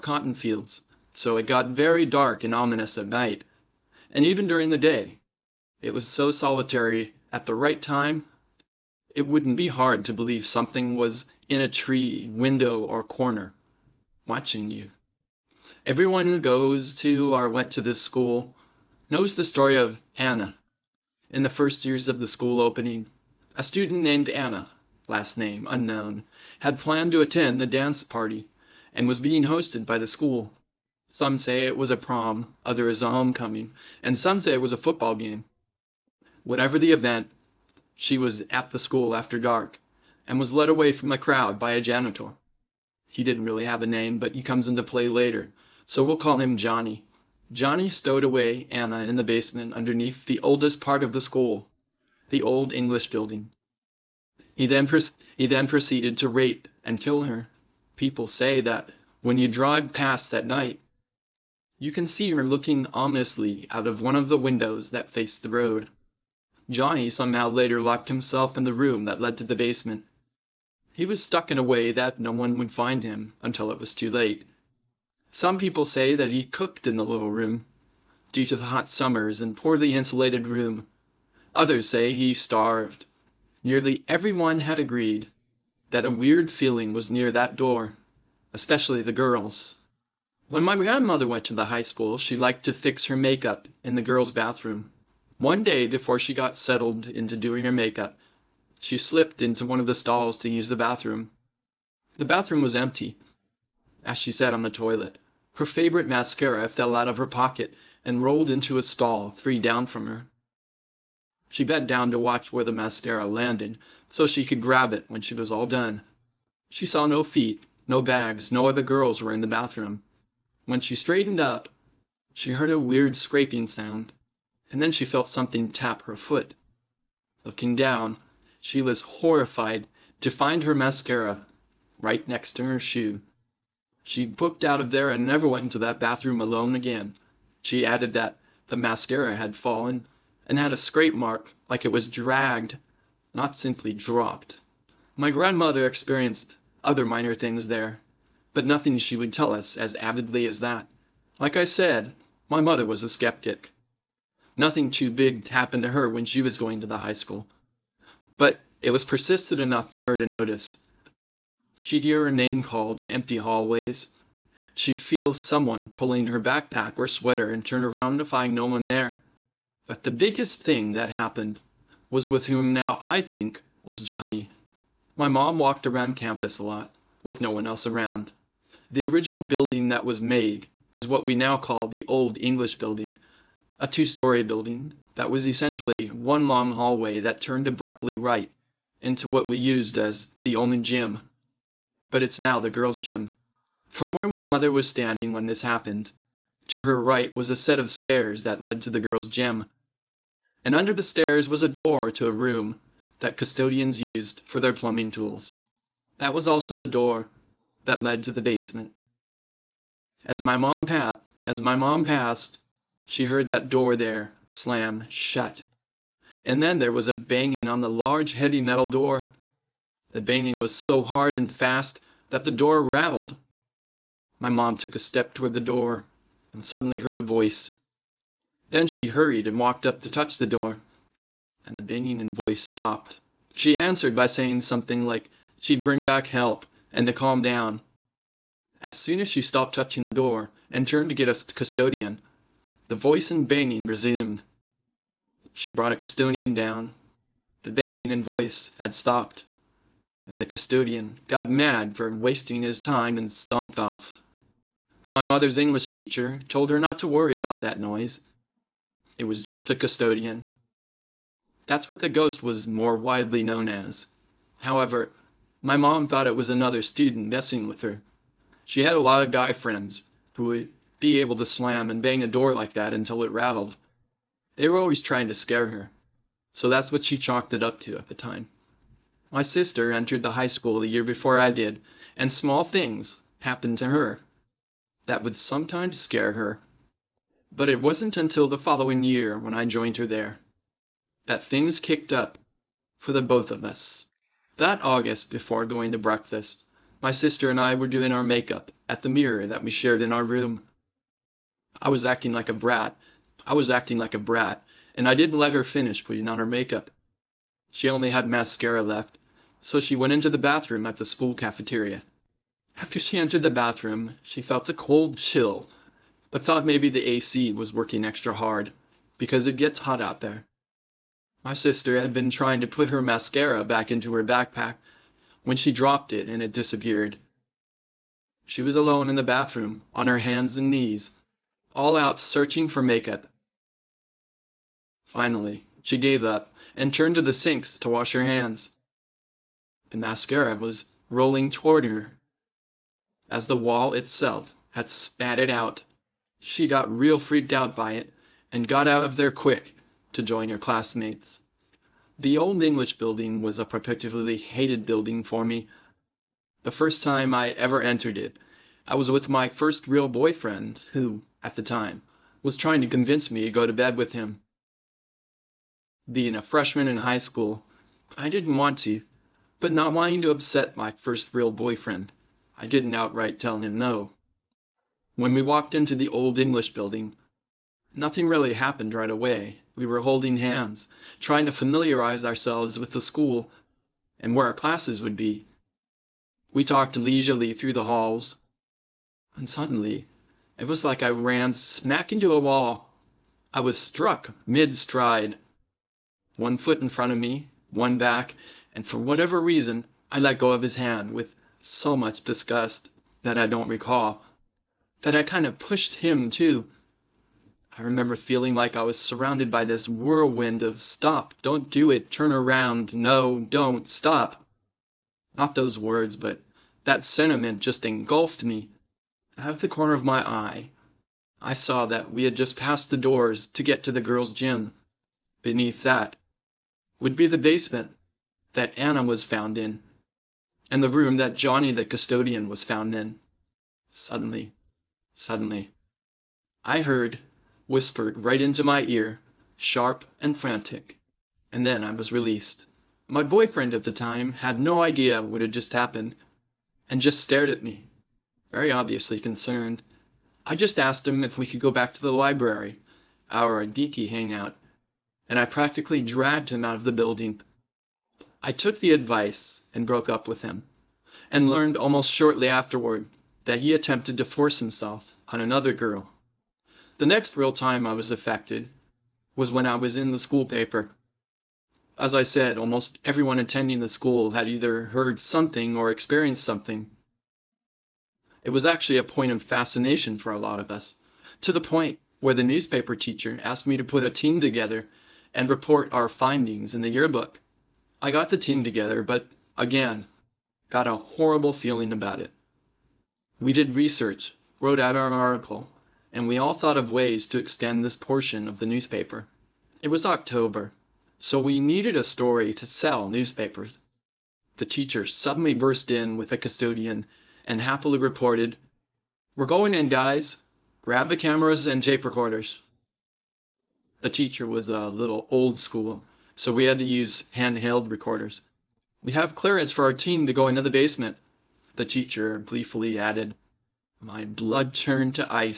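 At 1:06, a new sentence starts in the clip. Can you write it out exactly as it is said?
Johnny somehow later locked himself in the room that led to the basement.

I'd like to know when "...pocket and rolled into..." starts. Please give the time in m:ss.
1:47.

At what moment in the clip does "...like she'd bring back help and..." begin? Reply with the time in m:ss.
3:55.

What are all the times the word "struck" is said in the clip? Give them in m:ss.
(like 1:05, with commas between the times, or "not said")
6:33.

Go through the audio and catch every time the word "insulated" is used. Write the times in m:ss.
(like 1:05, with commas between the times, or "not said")
1:19.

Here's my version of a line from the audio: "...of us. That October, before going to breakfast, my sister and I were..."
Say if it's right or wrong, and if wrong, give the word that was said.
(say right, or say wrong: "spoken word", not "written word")
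wrong: "August", not "October".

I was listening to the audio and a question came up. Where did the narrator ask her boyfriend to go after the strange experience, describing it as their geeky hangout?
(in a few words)
The library.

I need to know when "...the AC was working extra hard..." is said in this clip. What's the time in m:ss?
5:16.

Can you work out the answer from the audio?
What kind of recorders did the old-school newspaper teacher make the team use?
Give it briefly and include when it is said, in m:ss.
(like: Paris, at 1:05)
Handheld recorders, at 8:37.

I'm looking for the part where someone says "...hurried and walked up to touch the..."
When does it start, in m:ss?
3:49.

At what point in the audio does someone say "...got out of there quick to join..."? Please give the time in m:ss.
5:48.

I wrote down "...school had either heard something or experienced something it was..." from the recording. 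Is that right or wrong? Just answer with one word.
right.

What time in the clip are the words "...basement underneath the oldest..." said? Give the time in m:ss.
0:49.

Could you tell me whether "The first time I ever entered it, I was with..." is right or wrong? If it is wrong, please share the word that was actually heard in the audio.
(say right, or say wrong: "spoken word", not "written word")
right.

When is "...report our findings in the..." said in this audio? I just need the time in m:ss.
8:05.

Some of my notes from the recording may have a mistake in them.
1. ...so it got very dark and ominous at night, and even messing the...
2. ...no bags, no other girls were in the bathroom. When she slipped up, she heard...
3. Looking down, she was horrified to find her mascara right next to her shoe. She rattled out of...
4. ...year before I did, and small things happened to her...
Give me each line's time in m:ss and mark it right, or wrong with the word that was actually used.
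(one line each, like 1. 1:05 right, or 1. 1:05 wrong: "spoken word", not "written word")
1. 0:01 wrong: "during", not "messing"
2. 1:57 wrong: "straightened", not "slipped"
3. 2:07 wrong: "booked", not "rattled"
4. 4:40 right.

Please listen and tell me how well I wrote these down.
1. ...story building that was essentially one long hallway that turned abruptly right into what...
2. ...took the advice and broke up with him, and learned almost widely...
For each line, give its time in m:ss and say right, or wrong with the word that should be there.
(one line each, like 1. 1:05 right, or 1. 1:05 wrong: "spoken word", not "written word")
1. 3:04 right
2. 7:38 wrong: "shortly", not "widely".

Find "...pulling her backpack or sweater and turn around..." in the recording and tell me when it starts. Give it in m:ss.
2:45.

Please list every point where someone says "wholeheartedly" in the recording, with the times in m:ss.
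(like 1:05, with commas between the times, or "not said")
not said.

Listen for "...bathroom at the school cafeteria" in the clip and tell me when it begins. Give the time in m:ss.
5:10.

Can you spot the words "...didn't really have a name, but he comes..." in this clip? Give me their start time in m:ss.
0:43.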